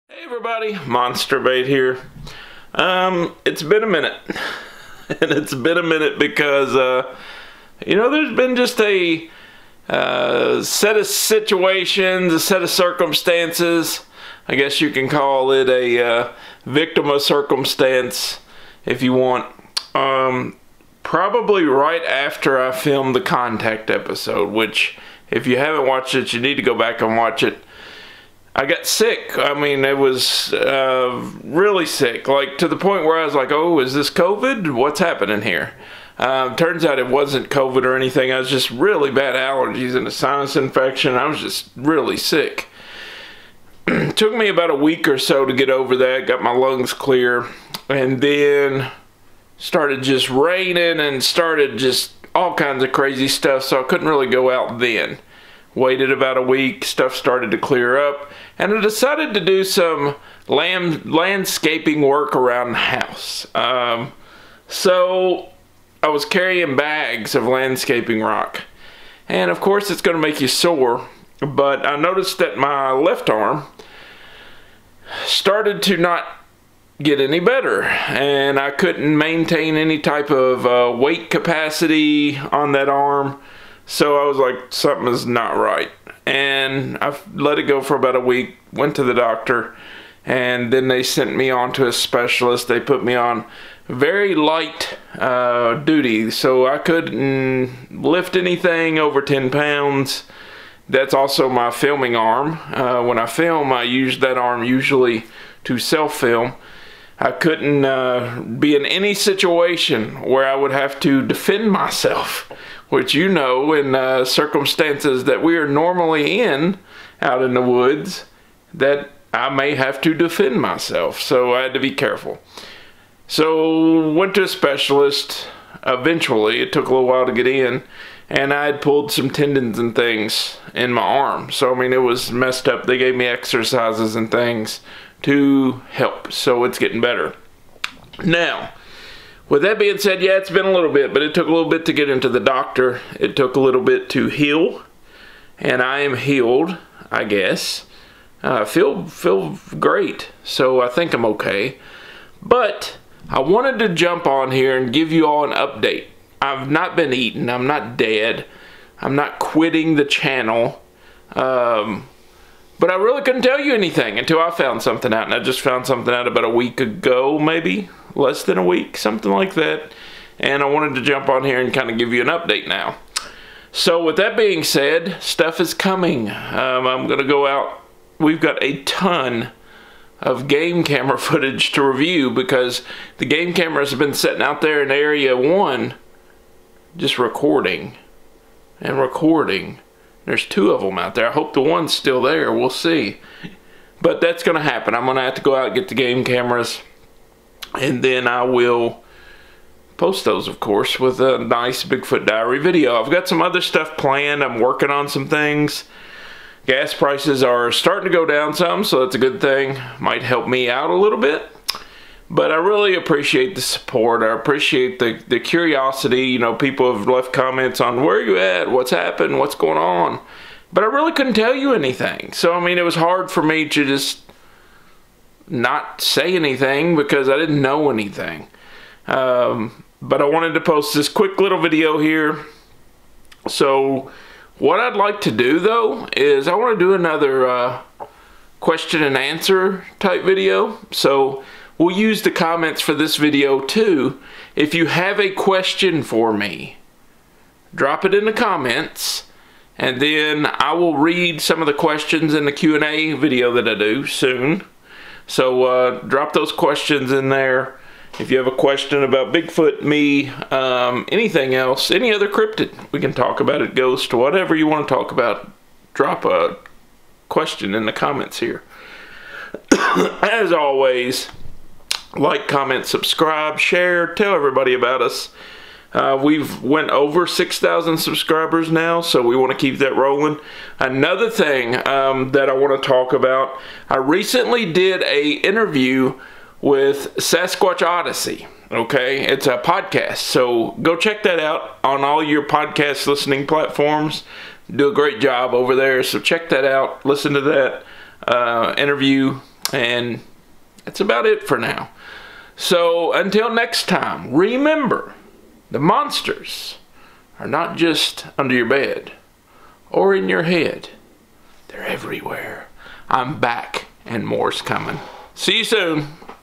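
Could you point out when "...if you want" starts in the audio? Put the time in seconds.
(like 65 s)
18 s.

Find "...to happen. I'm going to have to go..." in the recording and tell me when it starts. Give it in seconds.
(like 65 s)
194 s.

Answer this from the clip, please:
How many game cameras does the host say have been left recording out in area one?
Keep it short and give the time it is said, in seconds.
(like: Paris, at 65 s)
2, at 190 s.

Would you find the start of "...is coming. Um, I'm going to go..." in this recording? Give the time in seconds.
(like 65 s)
175 s.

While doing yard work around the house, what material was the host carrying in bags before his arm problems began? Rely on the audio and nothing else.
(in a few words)
landscaping rock.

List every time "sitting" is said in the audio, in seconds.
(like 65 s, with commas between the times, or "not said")
184 s.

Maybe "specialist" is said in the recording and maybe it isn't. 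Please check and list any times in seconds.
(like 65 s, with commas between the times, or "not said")
91 s, 124 s.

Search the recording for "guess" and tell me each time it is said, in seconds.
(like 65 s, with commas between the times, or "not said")
14 s, 147 s.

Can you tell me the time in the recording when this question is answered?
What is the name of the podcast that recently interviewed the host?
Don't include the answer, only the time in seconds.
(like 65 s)
287 s.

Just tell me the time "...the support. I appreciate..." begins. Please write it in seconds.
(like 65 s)
213 s.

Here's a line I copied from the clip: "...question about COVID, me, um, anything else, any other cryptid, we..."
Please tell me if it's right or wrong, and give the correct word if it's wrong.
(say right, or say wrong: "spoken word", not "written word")
wrong: "Bigfoot", not "COVID".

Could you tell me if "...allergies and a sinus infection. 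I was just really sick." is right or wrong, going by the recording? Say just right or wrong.
right.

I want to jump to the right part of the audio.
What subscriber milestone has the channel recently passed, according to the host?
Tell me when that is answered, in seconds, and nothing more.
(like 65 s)
277 s.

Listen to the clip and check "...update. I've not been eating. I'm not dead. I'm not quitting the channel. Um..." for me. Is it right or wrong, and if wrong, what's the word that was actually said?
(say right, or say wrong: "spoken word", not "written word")
right.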